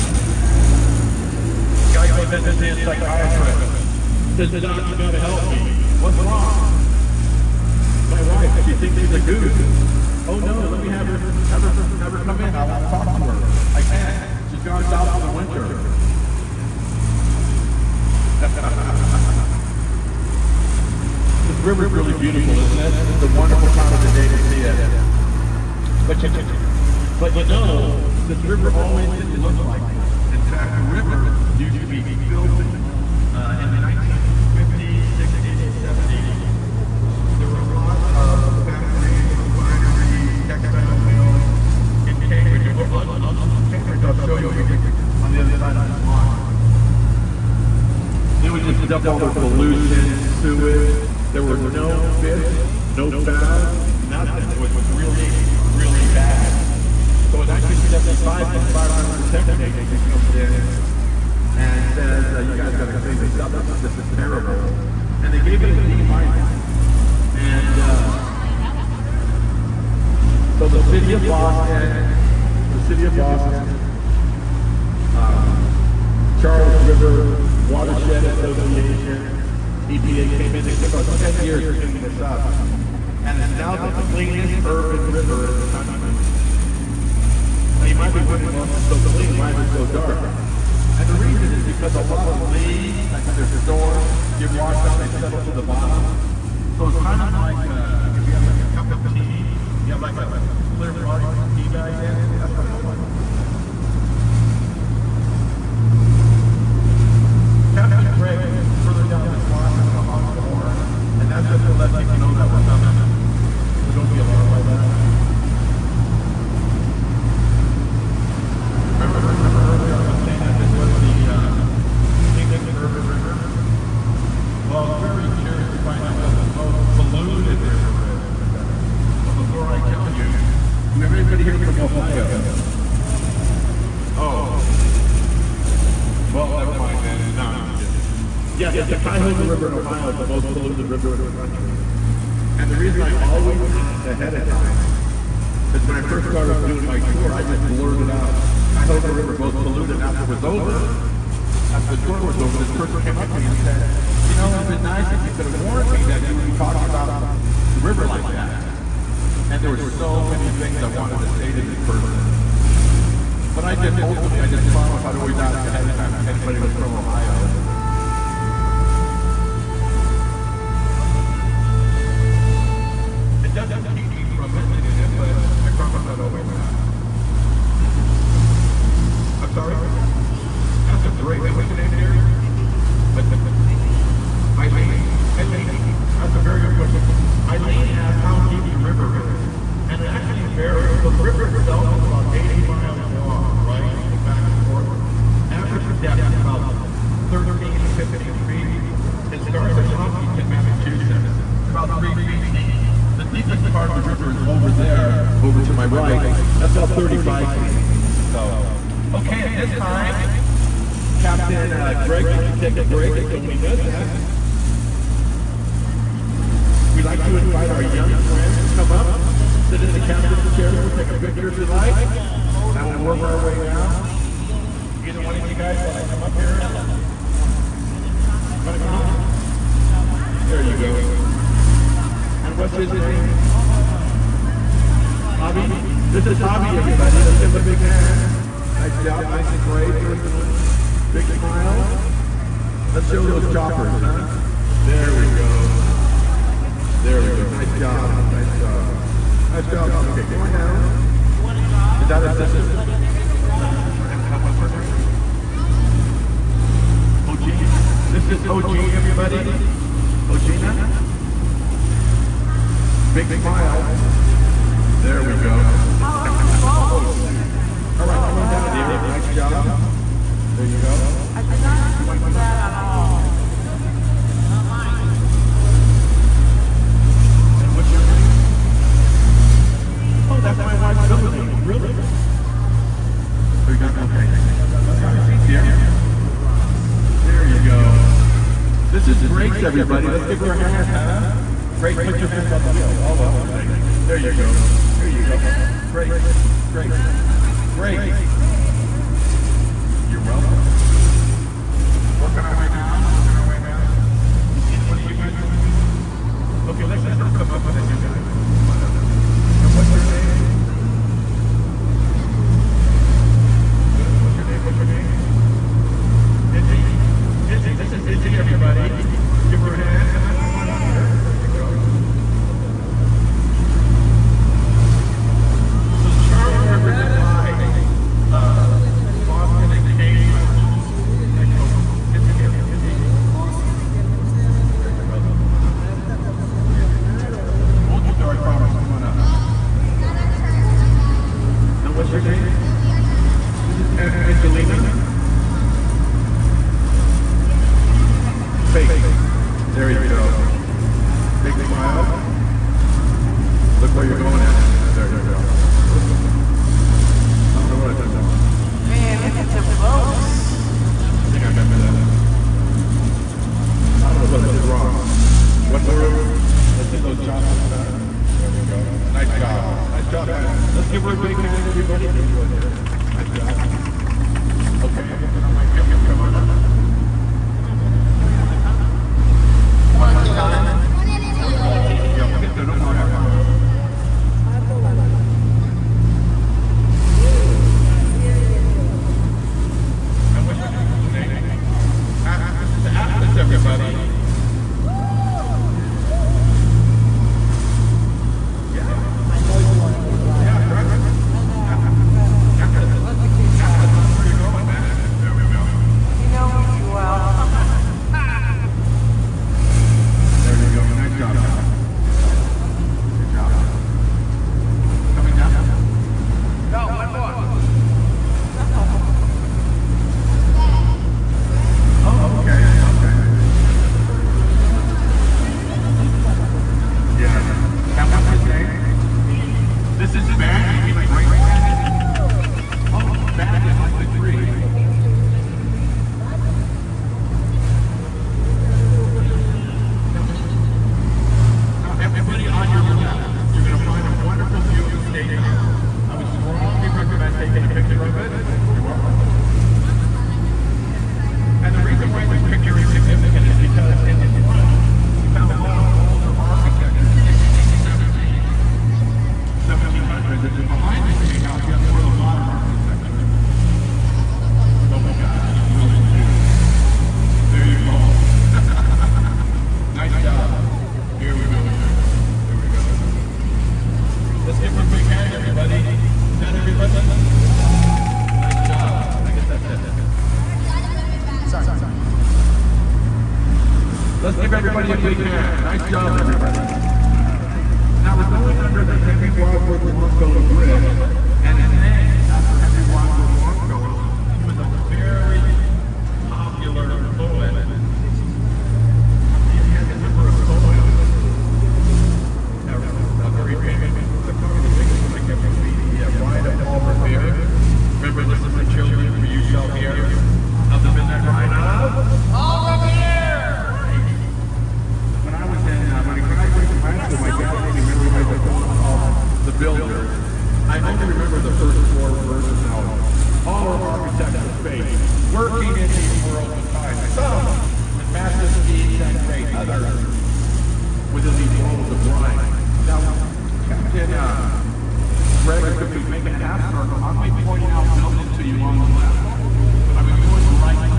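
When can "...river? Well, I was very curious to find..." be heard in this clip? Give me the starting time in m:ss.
2:03.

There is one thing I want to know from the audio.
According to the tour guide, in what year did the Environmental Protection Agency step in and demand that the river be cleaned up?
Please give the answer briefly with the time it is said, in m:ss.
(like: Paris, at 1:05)
1975, at 0:57.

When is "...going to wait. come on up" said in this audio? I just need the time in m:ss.
6:15.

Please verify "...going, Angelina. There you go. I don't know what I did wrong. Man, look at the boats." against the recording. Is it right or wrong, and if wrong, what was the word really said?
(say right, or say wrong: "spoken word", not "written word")
right.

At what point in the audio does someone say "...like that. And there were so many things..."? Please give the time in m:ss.
2:38.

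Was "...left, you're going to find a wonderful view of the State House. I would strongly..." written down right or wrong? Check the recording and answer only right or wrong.
right.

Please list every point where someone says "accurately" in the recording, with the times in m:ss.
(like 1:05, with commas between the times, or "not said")
not said.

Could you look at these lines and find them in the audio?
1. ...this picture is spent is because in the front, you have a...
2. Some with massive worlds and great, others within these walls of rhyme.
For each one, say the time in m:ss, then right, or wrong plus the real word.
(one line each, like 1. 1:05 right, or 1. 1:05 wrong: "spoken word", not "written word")
1. 7:32 wrong: "significant", not "spent"
2. 8:47 wrong: "speeds", not "worlds".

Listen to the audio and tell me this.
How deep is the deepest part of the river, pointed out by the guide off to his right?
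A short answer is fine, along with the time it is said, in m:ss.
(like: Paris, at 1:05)
35 feet, at 3:26.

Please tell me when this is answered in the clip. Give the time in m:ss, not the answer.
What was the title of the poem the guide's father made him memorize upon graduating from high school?
8:39.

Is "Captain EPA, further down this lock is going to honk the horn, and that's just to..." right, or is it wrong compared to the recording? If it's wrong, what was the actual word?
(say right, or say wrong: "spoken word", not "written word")
wrong: "Greg", not "EPA".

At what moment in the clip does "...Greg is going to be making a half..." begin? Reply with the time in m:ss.
8:55.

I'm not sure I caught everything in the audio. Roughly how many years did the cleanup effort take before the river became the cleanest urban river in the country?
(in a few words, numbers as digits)
10 years.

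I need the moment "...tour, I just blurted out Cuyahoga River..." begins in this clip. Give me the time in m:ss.
2:27.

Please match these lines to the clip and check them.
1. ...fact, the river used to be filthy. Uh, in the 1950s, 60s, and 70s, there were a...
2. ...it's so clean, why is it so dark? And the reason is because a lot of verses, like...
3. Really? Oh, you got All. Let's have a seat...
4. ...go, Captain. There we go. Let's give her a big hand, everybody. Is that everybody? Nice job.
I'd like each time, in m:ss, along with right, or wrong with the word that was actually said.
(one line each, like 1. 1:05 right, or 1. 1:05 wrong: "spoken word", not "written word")
1. 0:30 right
2. 1:28 wrong: "leaves", not "verses"
3. 4:41 wrong: "Okay", not "All"
4. 7:51 wrong: "Jack", not "Captain".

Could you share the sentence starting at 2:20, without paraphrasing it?
It's the most polluted river in the country.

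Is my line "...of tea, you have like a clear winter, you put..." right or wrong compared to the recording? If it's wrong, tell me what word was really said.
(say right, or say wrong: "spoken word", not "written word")
wrong: "water", not "winter".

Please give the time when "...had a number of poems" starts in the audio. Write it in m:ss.
8:19.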